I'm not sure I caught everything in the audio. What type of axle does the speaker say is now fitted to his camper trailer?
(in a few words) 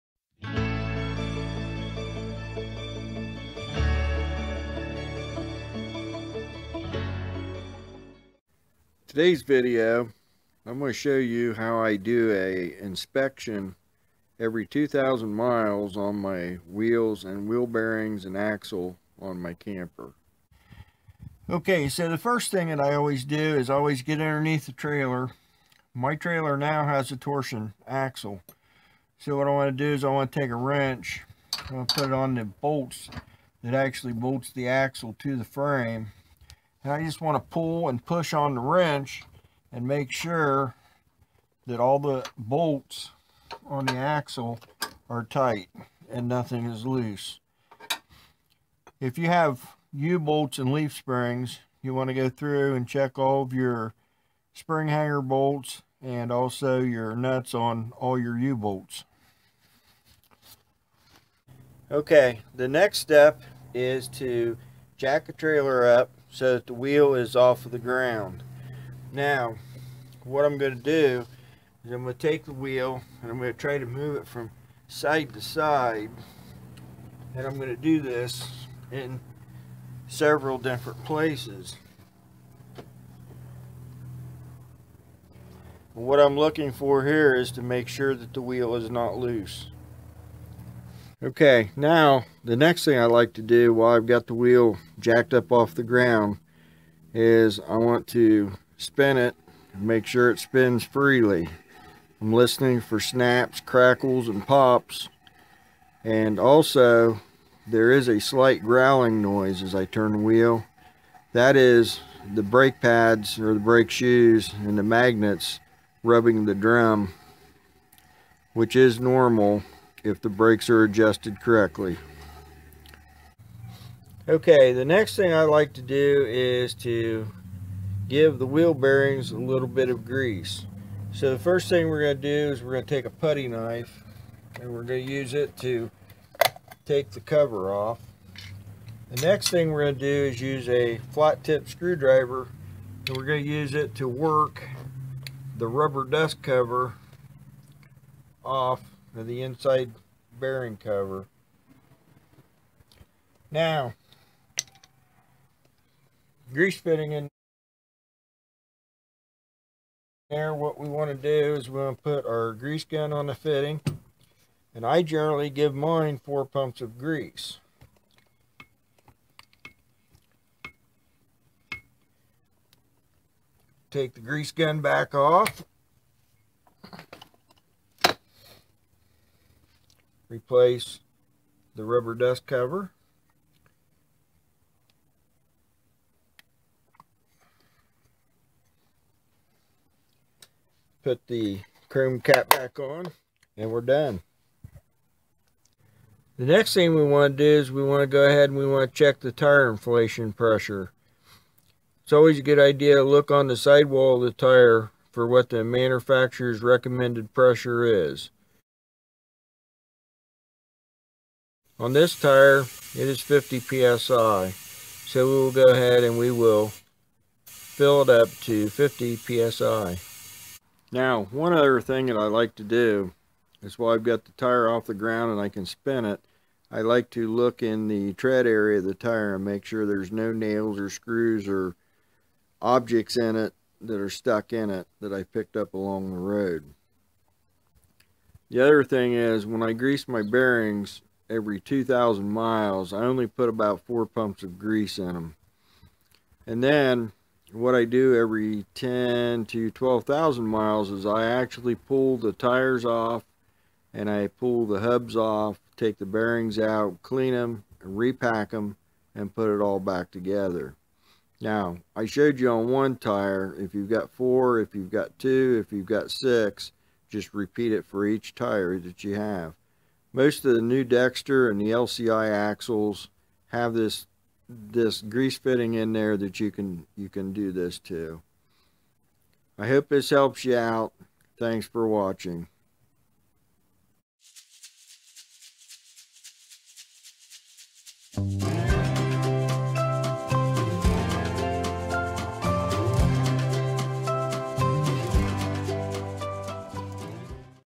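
torsion axle.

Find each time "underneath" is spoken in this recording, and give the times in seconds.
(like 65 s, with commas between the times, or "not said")
24 s.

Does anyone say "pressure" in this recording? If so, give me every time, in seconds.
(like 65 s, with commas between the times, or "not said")
200 s, 207 s.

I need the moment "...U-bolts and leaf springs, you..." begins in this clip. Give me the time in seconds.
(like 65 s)
49 s.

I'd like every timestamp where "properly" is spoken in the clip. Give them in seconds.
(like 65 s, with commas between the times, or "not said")
not said.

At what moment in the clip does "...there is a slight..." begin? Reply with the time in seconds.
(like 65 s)
107 s.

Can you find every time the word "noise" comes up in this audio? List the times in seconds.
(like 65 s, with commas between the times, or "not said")
109 s.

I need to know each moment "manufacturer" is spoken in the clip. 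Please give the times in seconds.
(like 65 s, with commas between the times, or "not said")
205 s.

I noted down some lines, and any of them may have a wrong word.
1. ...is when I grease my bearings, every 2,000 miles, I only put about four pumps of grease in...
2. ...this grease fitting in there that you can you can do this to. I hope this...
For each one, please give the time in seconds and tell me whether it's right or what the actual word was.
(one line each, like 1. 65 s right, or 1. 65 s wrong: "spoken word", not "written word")
1. 239 s right
2. 274 s right.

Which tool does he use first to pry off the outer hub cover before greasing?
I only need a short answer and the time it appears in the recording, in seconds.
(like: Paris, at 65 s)
putty knife, at 133 s.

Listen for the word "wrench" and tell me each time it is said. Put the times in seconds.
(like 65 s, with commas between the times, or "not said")
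30 s, 38 s.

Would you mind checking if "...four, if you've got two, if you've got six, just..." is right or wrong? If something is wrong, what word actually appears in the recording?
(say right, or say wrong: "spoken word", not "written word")
right.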